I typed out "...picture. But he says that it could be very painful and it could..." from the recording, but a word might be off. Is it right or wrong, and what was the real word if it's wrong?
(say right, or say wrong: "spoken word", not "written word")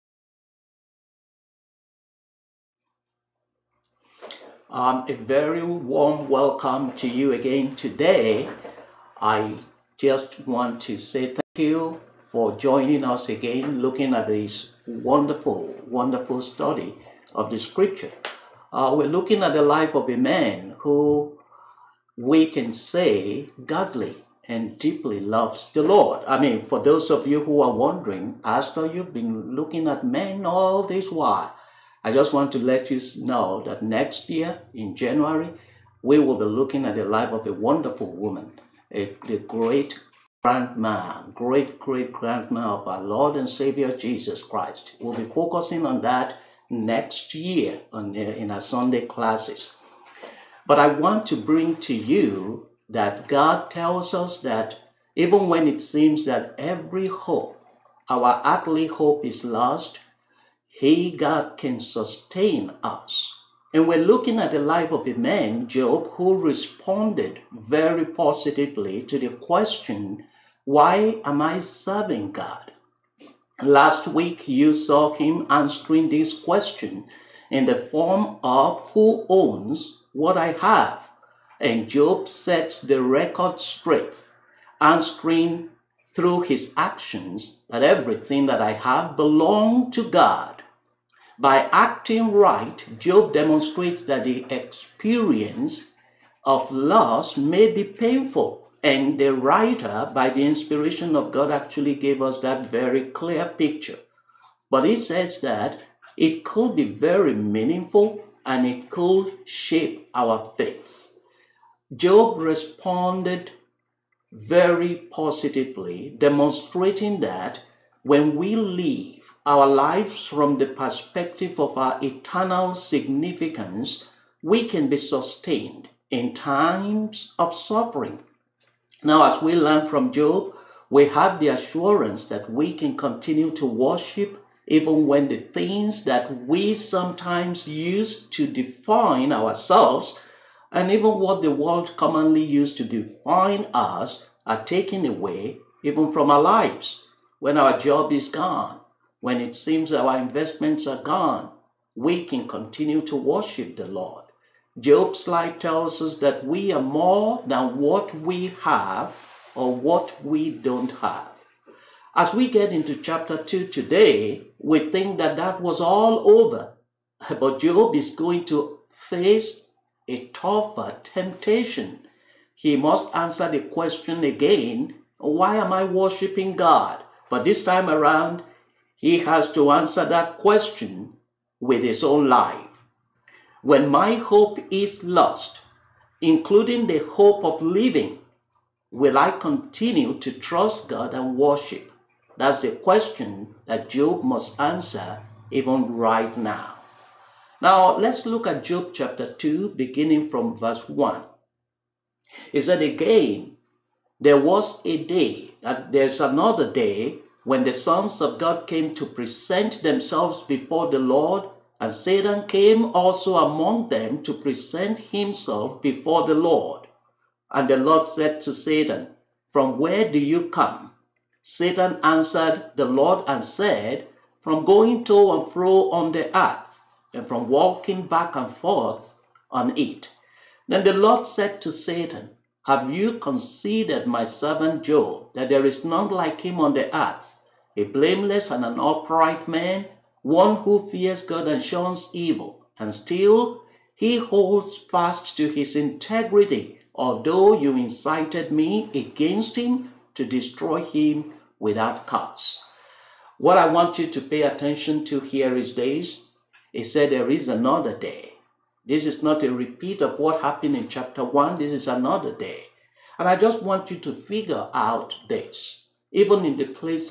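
wrong: "meaningful", not "painful".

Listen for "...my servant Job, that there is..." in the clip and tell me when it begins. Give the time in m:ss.
3:54.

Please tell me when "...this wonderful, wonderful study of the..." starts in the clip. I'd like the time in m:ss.
0:14.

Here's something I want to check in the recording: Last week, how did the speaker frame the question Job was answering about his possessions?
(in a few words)
Who owns what I have?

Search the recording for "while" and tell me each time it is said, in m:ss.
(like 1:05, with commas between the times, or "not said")
0:31.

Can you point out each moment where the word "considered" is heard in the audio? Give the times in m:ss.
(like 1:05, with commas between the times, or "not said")
3:53.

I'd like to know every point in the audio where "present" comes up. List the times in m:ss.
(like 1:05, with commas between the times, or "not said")
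3:29, 3:34.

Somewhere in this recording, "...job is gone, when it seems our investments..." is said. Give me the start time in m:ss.
2:27.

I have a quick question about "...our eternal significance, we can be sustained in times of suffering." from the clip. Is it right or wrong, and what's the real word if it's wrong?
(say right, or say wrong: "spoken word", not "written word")
right.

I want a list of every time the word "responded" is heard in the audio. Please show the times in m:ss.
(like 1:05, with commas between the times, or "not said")
1:06, 1:52.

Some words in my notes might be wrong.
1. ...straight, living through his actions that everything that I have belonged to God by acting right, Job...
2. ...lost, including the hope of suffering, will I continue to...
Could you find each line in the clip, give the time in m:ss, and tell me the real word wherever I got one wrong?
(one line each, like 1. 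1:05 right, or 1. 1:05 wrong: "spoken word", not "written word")
1. 1:23 wrong: "answering", not "living"
2. 3:05 wrong: "living", not "suffering".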